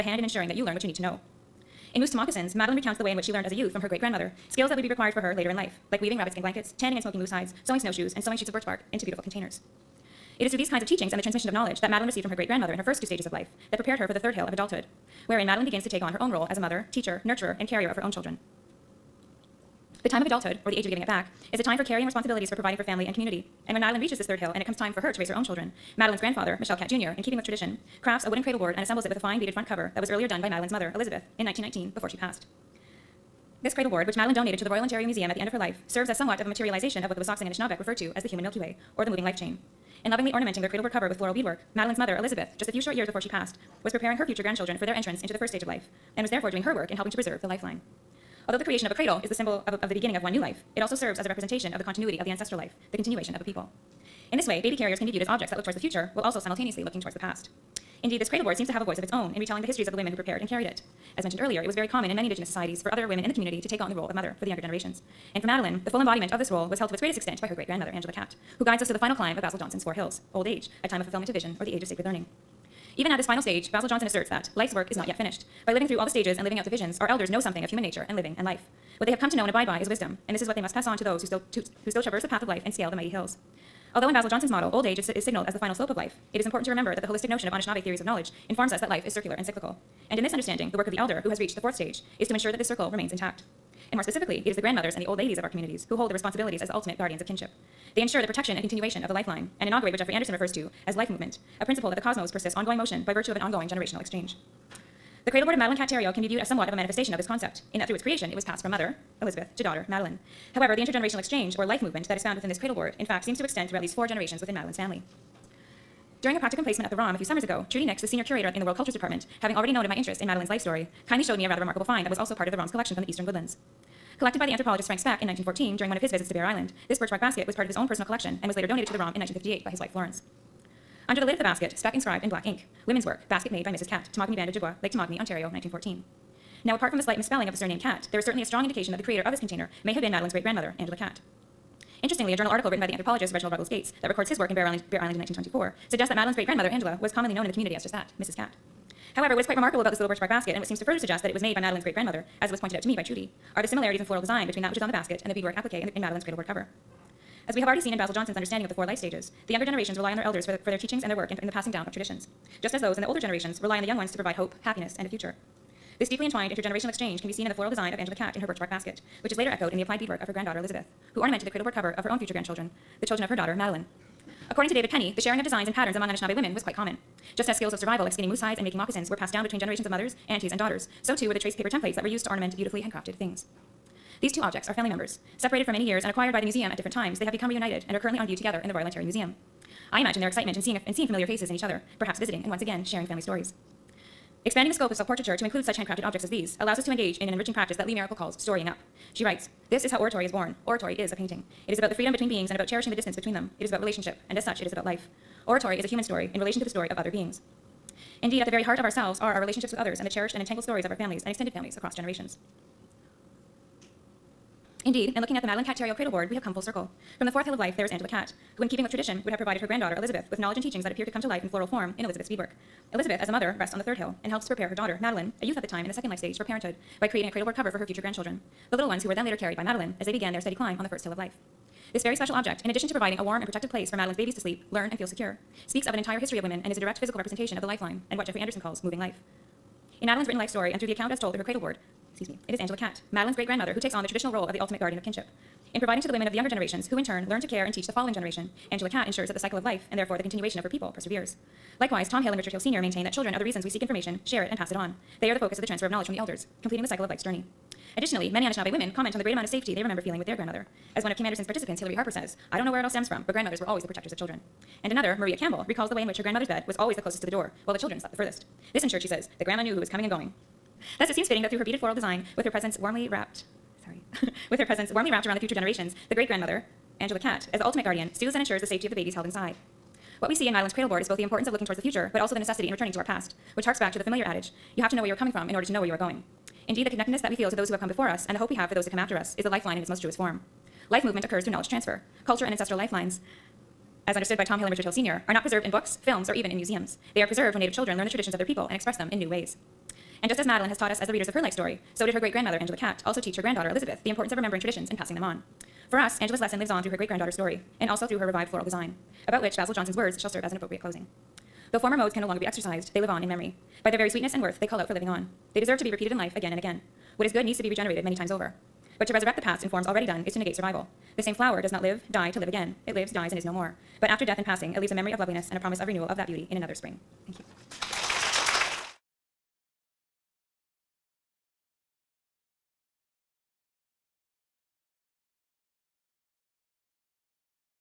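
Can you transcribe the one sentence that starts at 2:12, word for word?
Women's work, basket made by Mrs.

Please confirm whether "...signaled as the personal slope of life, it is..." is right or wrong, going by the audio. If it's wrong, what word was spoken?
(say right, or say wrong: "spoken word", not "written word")
wrong: "final", not "personal".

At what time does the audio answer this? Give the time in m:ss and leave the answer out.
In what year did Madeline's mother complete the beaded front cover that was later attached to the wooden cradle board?
0:31.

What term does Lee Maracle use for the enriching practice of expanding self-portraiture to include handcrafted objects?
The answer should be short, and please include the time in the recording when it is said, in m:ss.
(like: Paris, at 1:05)
storying up, at 3:18.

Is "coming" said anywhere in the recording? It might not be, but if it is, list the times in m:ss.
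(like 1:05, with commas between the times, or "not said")
4:29, 4:45.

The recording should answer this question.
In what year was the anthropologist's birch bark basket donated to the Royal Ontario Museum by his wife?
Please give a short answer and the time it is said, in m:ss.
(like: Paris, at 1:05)
1958, at 2:09.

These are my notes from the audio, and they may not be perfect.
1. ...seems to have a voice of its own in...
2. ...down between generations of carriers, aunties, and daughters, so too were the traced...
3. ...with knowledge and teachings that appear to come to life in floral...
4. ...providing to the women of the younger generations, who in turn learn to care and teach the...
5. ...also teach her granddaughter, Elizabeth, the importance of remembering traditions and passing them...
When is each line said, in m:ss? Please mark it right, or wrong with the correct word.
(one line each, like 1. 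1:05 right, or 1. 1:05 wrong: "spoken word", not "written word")
1. 0:58 right
2. 2:59 wrong: "mothers", not "carriers"
3. 3:40 right
4. 4:05 right
5. 5:03 right.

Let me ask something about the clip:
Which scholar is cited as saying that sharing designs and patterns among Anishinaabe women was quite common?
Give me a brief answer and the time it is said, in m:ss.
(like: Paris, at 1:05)
David Penney, at 2:54.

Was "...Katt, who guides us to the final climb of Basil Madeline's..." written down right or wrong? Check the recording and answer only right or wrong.
wrong.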